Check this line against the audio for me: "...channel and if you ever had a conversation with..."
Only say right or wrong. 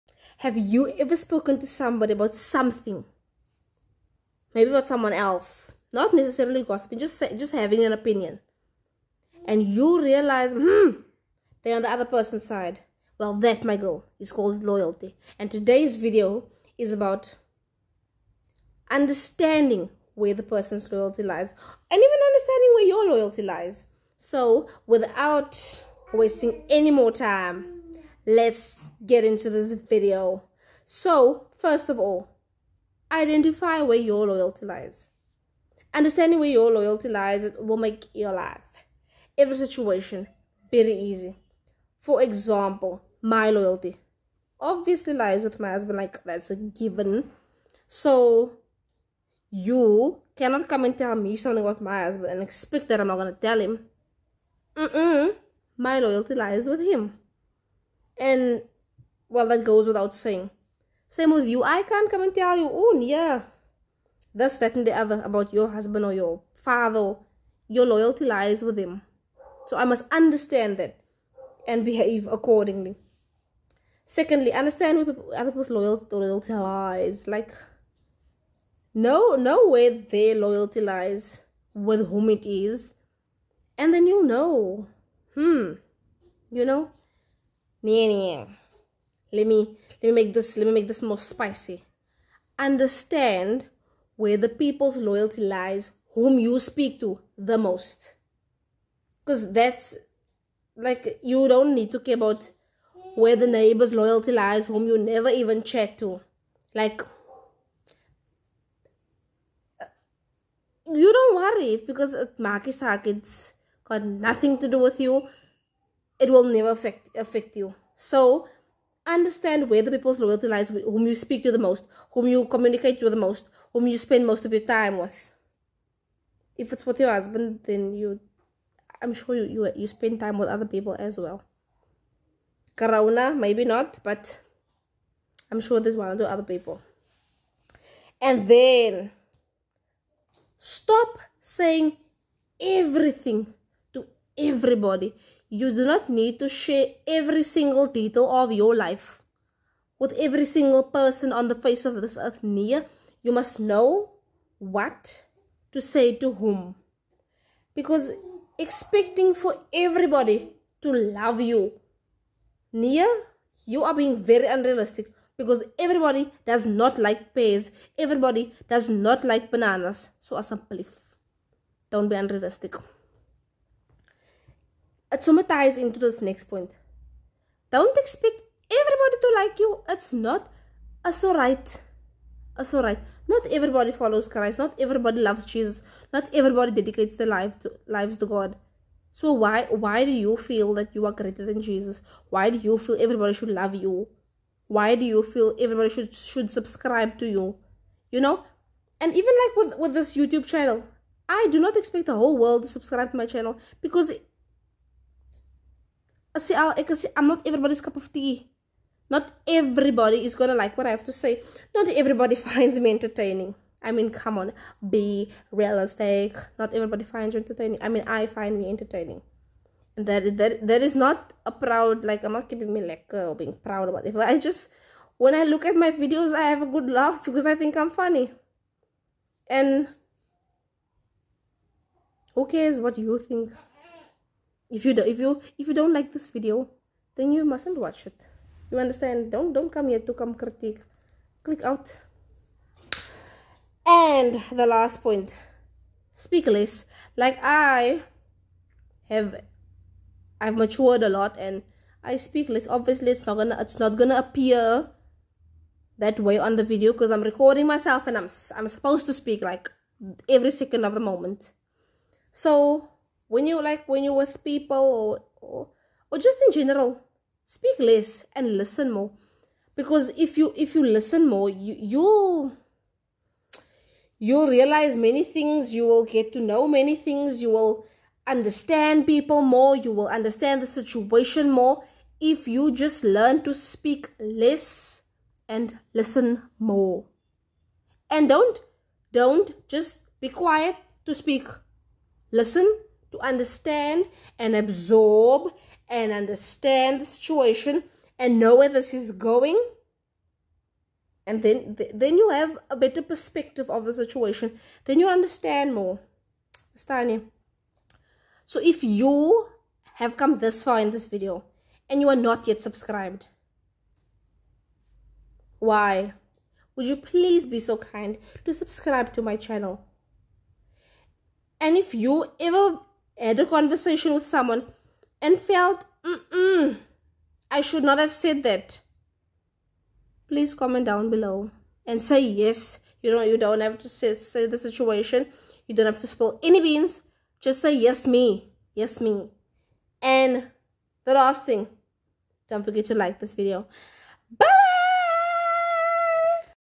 right.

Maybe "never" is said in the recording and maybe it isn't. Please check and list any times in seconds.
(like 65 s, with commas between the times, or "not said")
104 s, 116 s.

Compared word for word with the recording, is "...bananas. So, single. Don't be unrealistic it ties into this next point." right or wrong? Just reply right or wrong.
wrong.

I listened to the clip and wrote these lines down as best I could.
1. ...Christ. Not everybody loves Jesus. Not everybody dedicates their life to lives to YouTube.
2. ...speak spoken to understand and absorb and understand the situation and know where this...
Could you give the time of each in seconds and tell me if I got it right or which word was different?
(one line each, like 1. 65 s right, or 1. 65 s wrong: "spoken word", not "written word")
1. 184 s wrong: "God", not "YouTube"
2. 291 s wrong: "listen", not "spoken".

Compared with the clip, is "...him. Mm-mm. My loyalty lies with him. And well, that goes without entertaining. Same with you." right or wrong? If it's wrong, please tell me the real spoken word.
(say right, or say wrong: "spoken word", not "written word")
wrong: "saying", not "entertaining".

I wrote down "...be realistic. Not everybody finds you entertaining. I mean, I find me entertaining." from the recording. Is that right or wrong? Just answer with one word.
right.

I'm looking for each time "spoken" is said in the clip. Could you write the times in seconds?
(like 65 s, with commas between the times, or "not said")
1 s.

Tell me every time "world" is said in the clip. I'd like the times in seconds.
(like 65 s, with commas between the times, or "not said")
202 s.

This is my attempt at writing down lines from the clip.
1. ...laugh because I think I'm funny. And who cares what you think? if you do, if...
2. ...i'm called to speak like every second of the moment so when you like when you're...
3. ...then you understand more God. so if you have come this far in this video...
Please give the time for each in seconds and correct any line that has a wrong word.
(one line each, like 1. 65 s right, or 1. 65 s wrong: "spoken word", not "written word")
1. 226 s right
2. 258 s wrong: "supposed", not "called"
3. 304 s wrong: "Stani", not "God".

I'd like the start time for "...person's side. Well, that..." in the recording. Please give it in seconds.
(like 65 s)
12 s.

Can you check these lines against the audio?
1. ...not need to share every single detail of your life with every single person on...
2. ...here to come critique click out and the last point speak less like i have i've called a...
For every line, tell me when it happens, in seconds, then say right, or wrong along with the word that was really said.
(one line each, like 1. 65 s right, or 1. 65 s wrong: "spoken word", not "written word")
1. 145 s right
2. 239 s wrong: "matured", not "called".